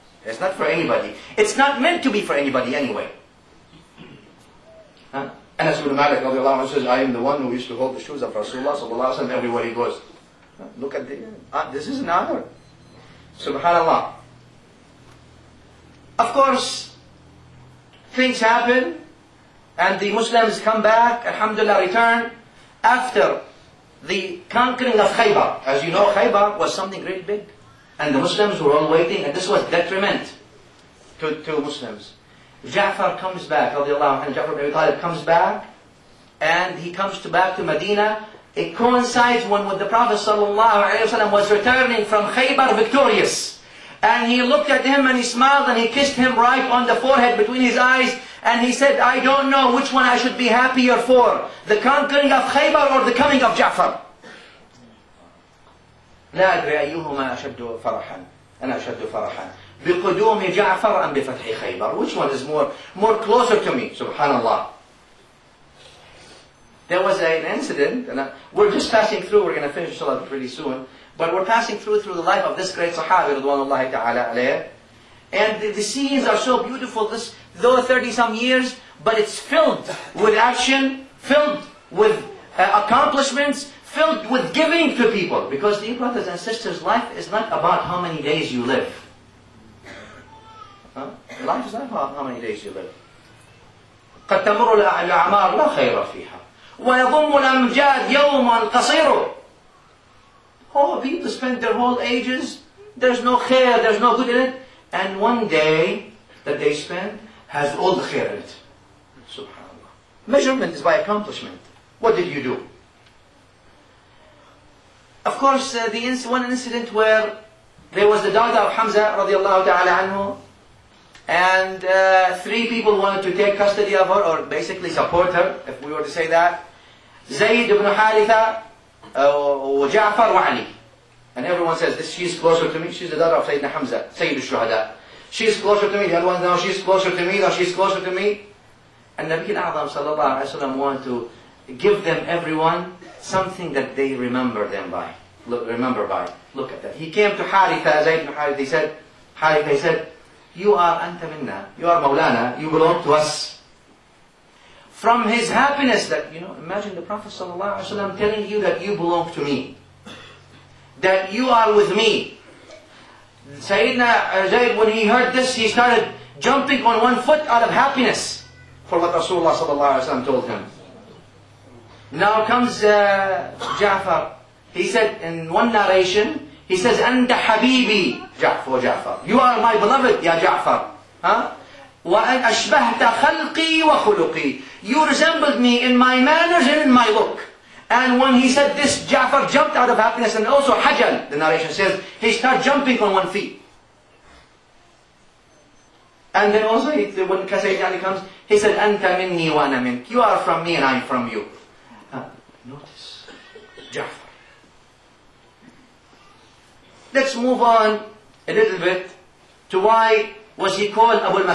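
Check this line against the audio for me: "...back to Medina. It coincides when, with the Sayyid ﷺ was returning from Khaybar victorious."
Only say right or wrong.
wrong.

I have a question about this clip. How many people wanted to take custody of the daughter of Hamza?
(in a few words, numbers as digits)
3.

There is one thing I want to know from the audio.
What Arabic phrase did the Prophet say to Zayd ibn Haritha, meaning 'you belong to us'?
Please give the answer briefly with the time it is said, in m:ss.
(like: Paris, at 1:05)
anta minna, at 2:30.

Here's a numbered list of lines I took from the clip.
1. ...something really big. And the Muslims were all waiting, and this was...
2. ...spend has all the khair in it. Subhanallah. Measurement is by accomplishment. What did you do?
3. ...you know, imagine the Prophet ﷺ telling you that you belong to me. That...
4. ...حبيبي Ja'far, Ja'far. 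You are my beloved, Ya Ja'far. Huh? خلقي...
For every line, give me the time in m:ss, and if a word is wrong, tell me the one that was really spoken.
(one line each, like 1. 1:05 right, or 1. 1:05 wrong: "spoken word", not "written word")
1. 0:26 right
2. 1:46 right
3. 2:36 right
4. 2:57 right.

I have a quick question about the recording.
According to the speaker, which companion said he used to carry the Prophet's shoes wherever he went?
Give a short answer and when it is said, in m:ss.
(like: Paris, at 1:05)
Anas ibn Malik, at 0:05.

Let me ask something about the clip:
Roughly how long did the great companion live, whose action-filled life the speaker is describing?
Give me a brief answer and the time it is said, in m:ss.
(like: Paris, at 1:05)
30 some years, at 1:17.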